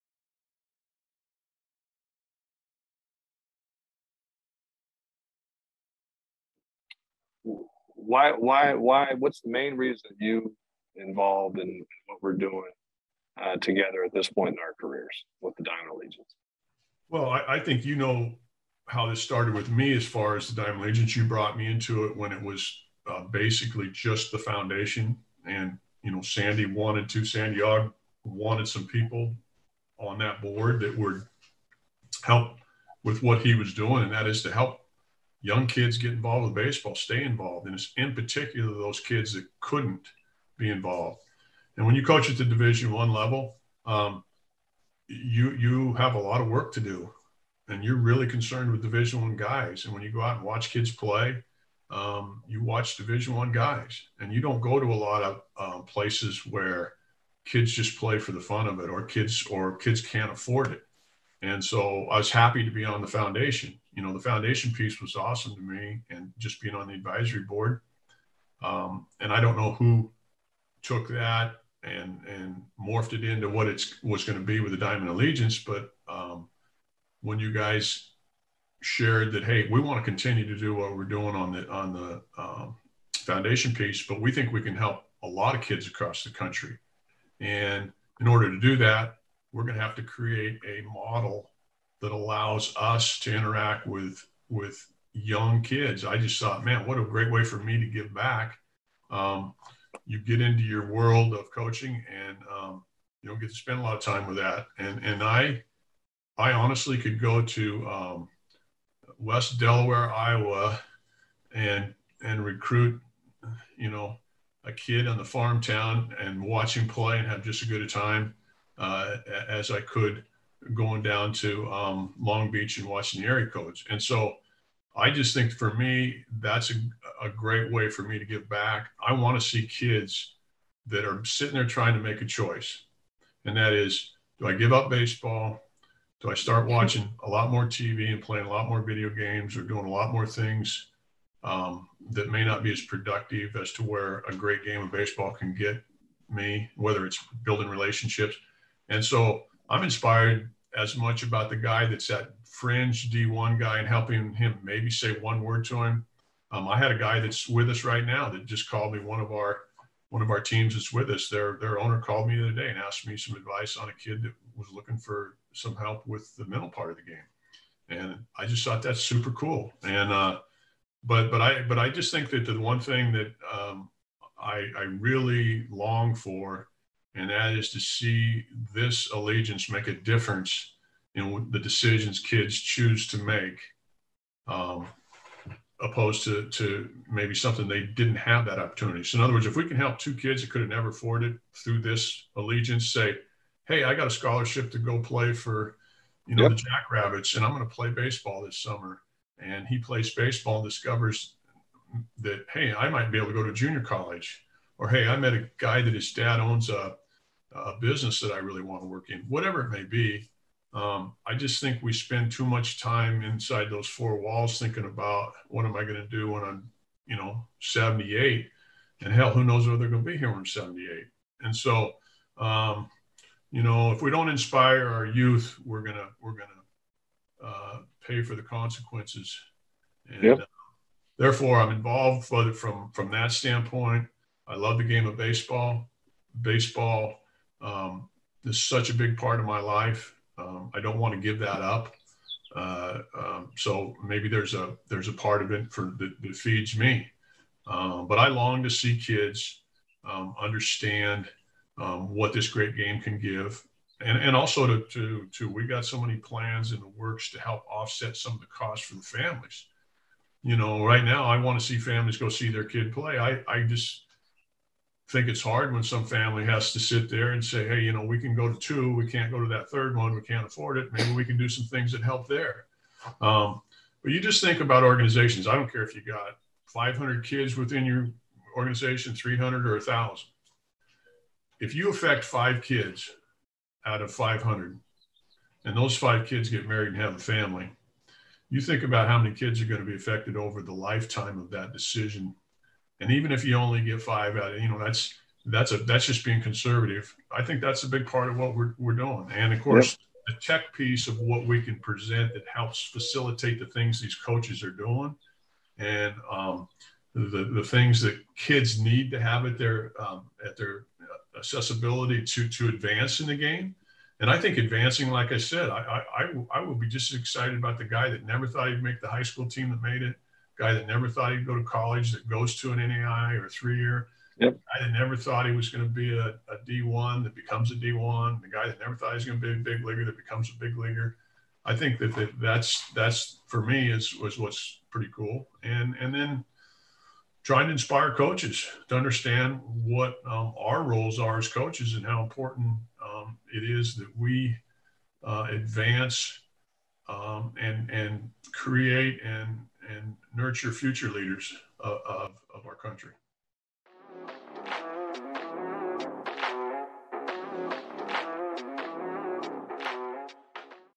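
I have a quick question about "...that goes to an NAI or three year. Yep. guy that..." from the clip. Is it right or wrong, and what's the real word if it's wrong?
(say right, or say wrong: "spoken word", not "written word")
right.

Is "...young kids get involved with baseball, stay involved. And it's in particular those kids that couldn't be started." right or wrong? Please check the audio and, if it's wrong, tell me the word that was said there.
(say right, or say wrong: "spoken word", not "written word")
wrong: "involved", not "started".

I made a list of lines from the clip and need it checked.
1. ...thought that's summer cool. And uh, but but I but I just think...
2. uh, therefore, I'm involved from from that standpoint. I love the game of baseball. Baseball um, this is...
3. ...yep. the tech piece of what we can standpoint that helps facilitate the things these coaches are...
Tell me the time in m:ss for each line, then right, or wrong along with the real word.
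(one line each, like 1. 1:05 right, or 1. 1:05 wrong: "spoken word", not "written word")
1. 2:48 wrong: "super", not "summer"
2. 3:50 right
3. 4:59 wrong: "present", not "standpoint".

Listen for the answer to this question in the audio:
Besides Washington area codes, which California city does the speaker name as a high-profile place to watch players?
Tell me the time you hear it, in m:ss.
2:02.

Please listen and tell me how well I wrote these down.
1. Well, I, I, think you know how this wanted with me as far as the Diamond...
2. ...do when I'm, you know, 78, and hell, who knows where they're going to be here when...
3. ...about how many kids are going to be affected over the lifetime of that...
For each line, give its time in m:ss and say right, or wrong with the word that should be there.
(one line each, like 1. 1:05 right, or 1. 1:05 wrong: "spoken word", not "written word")
1. 0:17 wrong: "started", not "wanted"
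2. 3:36 right
3. 4:48 right.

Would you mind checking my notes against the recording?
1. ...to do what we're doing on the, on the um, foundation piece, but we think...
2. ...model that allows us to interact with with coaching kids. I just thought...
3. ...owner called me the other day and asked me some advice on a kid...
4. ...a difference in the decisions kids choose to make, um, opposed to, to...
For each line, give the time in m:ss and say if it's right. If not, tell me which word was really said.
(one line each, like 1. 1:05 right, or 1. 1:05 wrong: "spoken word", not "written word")
1. 1:20 right
2. 1:30 wrong: "young", not "coaching"
3. 2:41 right
4. 2:59 right.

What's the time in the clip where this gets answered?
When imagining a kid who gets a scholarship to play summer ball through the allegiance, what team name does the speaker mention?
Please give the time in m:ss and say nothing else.
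3:16.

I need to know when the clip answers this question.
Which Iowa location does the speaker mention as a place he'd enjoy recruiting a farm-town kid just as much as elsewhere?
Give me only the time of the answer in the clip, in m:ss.
1:49.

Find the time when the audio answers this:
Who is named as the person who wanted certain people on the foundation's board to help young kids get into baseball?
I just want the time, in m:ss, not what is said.
0:27.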